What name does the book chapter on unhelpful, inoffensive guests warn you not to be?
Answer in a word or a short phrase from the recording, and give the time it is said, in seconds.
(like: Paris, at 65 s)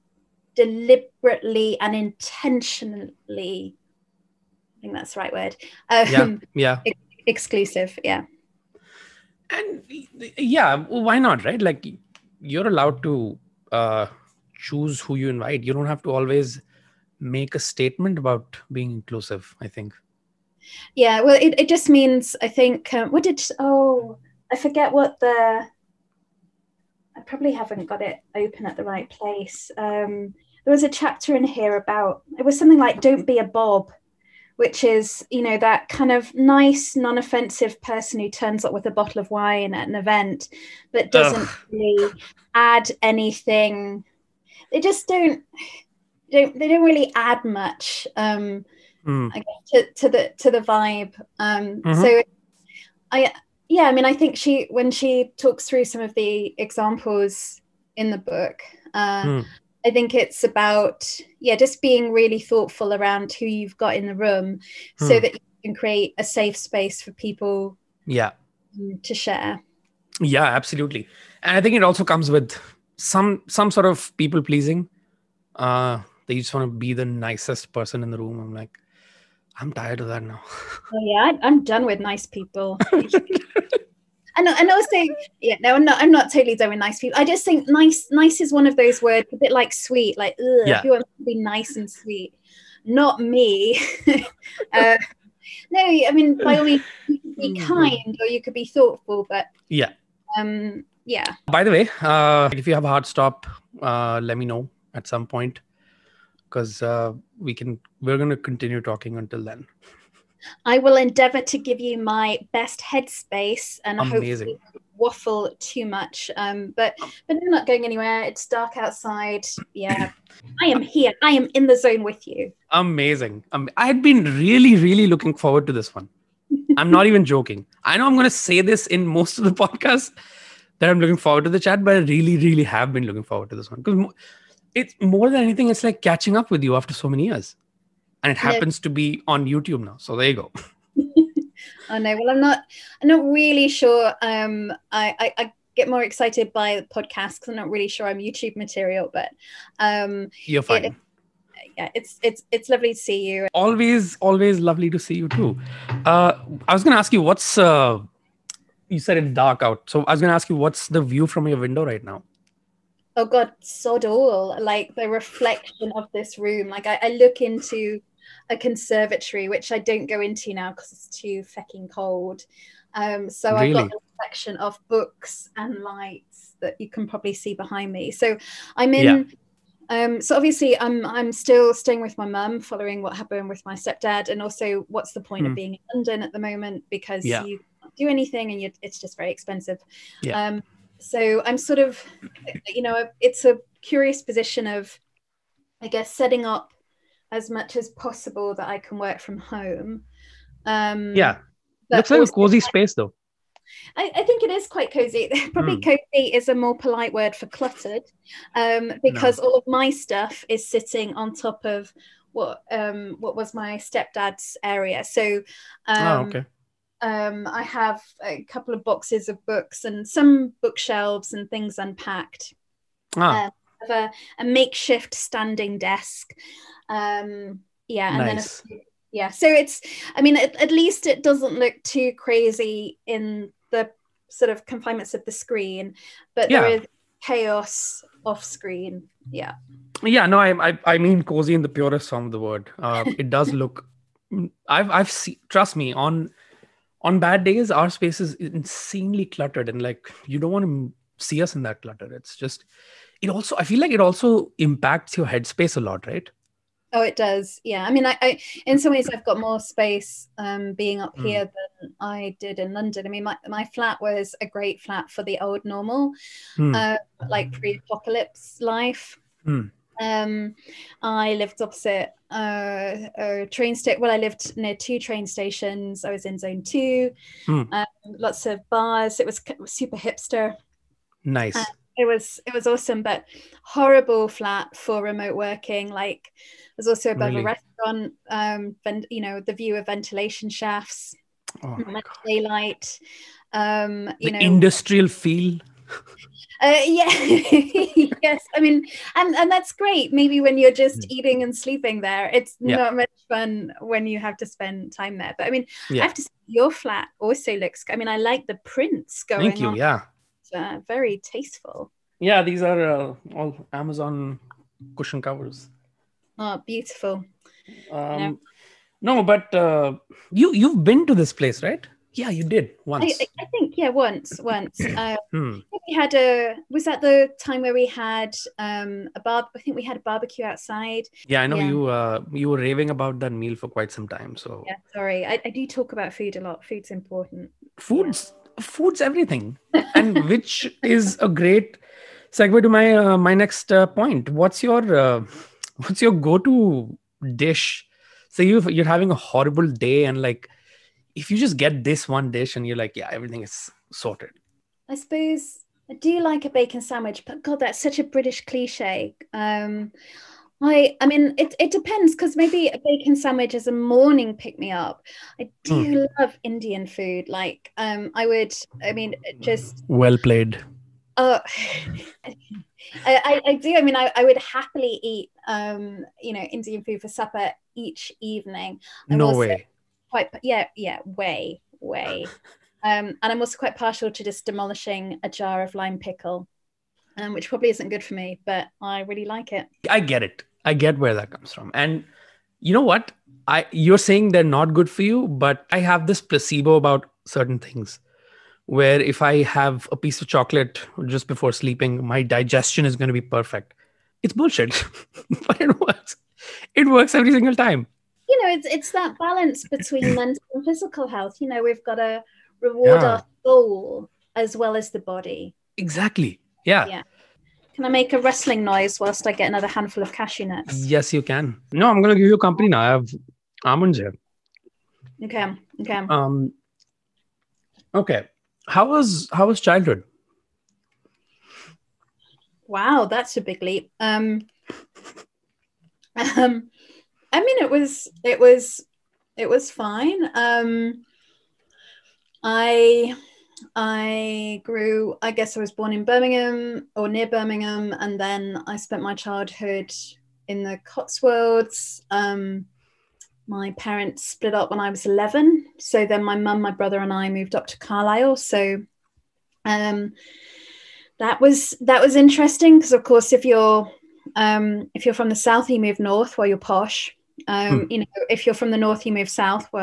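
Bob, at 33 s.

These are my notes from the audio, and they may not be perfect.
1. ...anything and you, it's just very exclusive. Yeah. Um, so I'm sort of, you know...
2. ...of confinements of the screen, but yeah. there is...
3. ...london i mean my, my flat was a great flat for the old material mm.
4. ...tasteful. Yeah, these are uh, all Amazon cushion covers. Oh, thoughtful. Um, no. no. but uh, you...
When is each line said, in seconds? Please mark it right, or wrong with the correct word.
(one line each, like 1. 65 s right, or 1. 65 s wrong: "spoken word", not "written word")
1. 188 s wrong: "expensive", not "exclusive"
2. 234 s right
3. 262 s wrong: "normal", not "material"
4. 311 s wrong: "beautiful", not "thoughtful".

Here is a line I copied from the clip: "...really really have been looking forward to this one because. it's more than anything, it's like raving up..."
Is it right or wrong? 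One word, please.
wrong.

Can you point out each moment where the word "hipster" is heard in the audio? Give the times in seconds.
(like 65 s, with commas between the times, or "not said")
279 s.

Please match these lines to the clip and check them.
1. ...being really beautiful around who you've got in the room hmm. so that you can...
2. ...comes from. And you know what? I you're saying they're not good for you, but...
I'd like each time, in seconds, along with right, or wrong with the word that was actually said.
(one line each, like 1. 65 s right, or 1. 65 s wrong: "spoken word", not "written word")
1. 61 s wrong: "thoughtful", not "beautiful"
2. 391 s right.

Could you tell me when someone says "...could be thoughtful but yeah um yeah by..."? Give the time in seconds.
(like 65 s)
98 s.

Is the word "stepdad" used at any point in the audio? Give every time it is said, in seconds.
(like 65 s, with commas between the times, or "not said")
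183 s, 213 s.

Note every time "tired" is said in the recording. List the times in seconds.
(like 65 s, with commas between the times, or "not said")
79 s.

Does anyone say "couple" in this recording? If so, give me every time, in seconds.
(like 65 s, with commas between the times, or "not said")
218 s.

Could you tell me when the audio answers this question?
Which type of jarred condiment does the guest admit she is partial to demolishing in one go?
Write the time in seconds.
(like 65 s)
385 s.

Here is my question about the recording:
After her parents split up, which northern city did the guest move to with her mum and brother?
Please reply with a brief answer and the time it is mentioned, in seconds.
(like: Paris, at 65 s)
Carlisle, at 457 s.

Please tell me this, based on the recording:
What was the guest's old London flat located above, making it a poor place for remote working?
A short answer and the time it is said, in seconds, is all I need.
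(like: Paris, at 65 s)
A restaurant, at 287 s.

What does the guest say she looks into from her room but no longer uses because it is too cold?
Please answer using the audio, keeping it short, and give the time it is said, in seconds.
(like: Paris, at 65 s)
A conservatory, at 168 s.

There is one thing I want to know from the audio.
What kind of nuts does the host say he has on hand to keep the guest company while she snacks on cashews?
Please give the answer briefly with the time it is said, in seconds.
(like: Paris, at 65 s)
Almonds, at 423 s.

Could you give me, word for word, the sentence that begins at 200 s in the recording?
Um, yeah, looks like a cozy space though.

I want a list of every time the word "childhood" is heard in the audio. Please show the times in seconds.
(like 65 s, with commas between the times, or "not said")
429 s, 449 s.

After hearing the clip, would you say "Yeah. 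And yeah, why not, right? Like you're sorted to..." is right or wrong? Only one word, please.
wrong.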